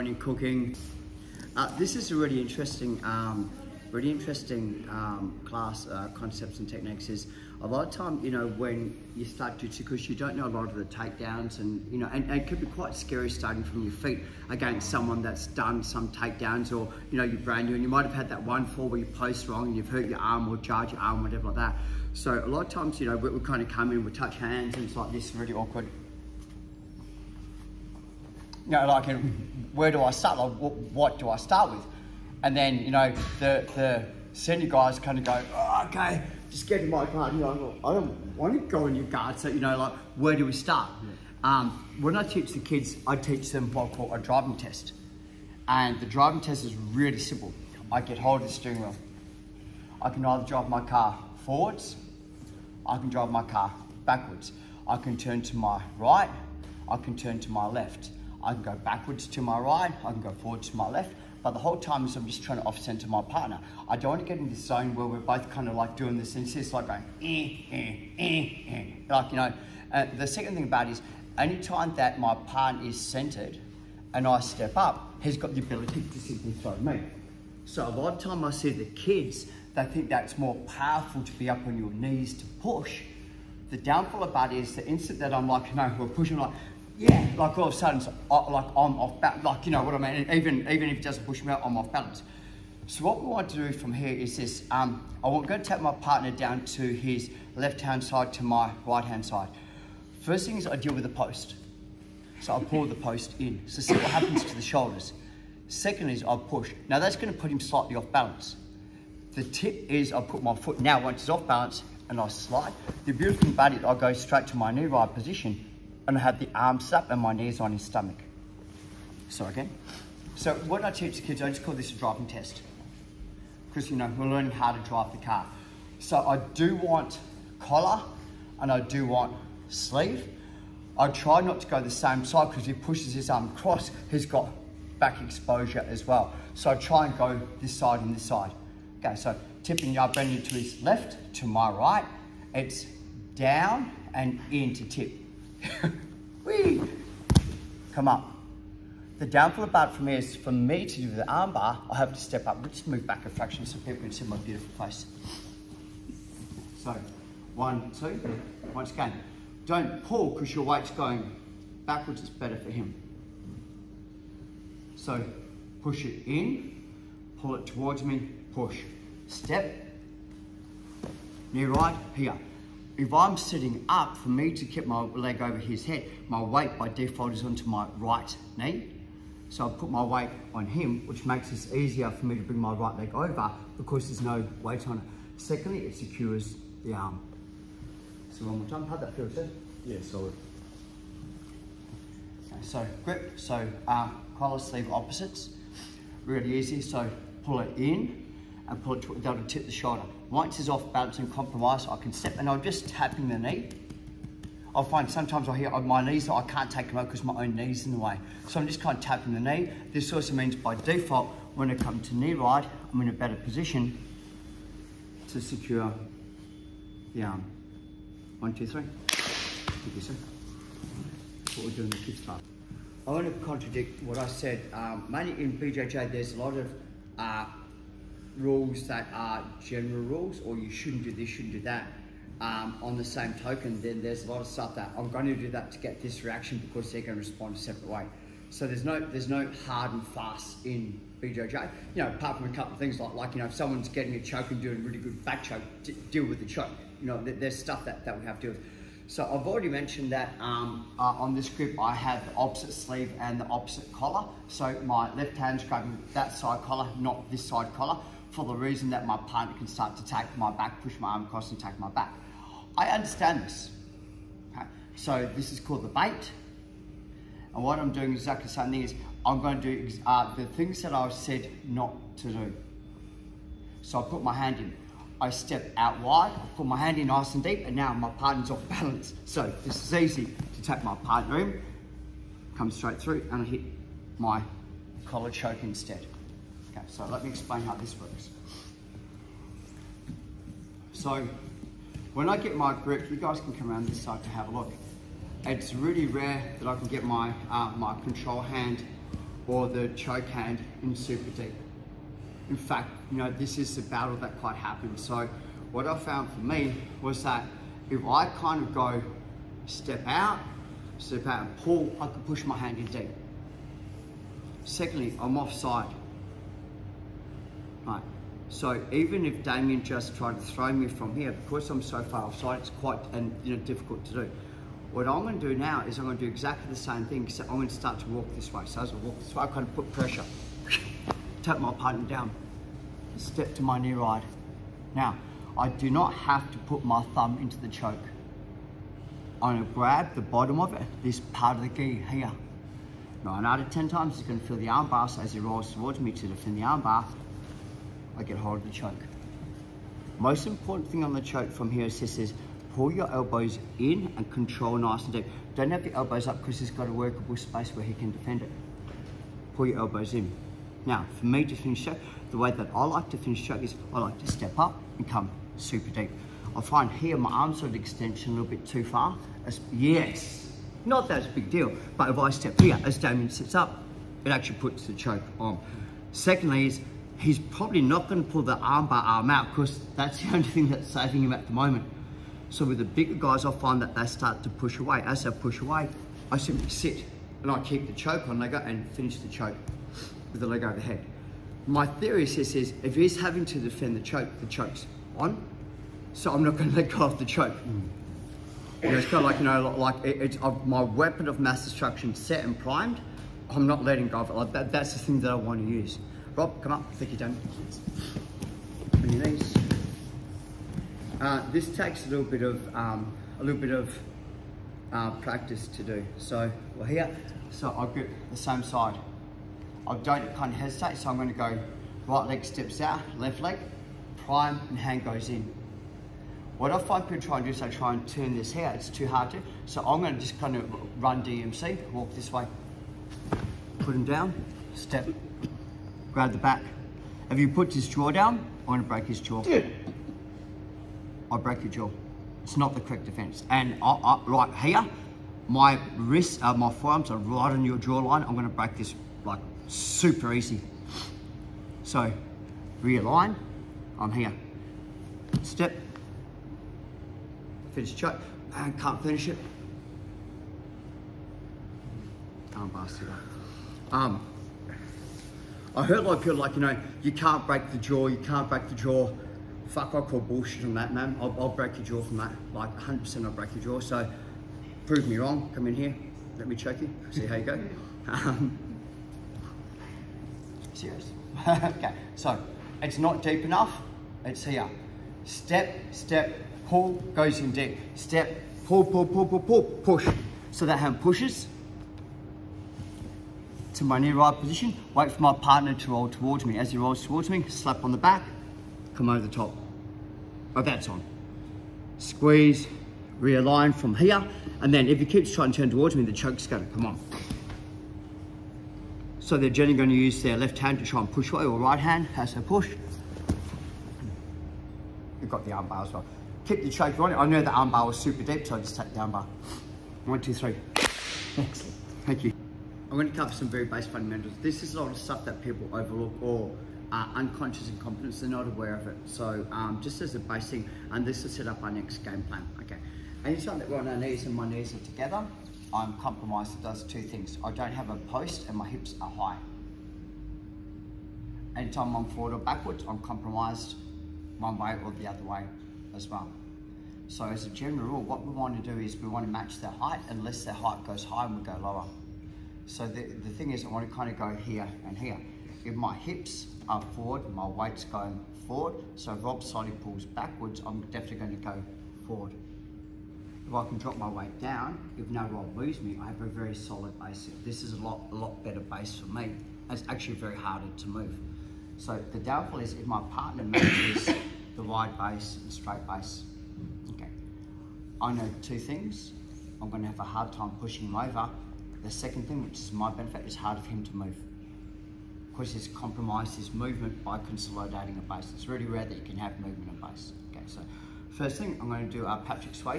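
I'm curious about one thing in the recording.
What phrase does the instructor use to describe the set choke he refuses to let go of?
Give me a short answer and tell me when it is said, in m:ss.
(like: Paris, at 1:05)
weapon of mass destruction, at 6:40.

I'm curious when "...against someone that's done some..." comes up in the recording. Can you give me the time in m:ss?
0:14.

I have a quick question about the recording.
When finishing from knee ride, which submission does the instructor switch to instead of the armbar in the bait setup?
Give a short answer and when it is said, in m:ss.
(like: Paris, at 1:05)
collar choke, at 4:45.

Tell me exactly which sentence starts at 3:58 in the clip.
So there's no there's no hard and fast in BJJ.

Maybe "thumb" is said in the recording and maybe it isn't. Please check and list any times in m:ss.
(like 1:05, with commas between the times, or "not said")
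5:37.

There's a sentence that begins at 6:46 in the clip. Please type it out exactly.
Rob, come up, Thank you, down.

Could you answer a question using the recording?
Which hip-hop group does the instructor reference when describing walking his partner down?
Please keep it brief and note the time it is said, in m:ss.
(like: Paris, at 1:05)
Run-DMC, at 7:11.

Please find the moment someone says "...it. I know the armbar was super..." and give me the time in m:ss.
8:37.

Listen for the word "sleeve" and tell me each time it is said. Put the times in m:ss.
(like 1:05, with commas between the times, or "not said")
2:09, 3:14, 4:12.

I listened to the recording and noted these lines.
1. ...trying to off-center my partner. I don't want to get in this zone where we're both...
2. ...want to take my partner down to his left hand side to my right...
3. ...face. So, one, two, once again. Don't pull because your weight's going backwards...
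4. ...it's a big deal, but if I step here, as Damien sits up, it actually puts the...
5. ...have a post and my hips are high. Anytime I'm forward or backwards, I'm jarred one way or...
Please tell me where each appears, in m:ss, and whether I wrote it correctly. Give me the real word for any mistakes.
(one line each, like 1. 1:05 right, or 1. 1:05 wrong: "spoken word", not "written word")
1. 1:02 right
2. 1:35 right
3. 2:34 right
4. 6:11 right
5. 8:57 wrong: "compromised", not "jarred".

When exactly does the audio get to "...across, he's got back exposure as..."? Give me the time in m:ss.
2:13.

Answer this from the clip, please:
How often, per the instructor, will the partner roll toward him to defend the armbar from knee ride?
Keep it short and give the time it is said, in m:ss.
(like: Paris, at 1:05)
9 out of 10 times, at 5:43.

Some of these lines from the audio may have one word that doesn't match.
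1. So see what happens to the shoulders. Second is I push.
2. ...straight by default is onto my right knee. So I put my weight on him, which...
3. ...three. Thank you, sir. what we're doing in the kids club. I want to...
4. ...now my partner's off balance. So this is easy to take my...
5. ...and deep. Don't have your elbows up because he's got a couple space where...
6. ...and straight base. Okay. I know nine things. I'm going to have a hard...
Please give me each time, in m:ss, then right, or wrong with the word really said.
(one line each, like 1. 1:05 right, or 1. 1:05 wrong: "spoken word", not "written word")
1. 1:43 right
2. 2:56 wrong: "weight", not "straight"
3. 3:38 right
4. 4:37 right
5. 5:55 wrong: "workable", not "couple"
6. 9:35 wrong: "two", not "nine".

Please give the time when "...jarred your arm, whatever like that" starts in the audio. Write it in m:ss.
0:20.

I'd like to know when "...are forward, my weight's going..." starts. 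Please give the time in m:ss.
9:16.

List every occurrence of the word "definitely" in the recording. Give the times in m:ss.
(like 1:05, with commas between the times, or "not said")
9:20.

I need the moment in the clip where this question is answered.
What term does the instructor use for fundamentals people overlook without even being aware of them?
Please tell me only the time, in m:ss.
8:47.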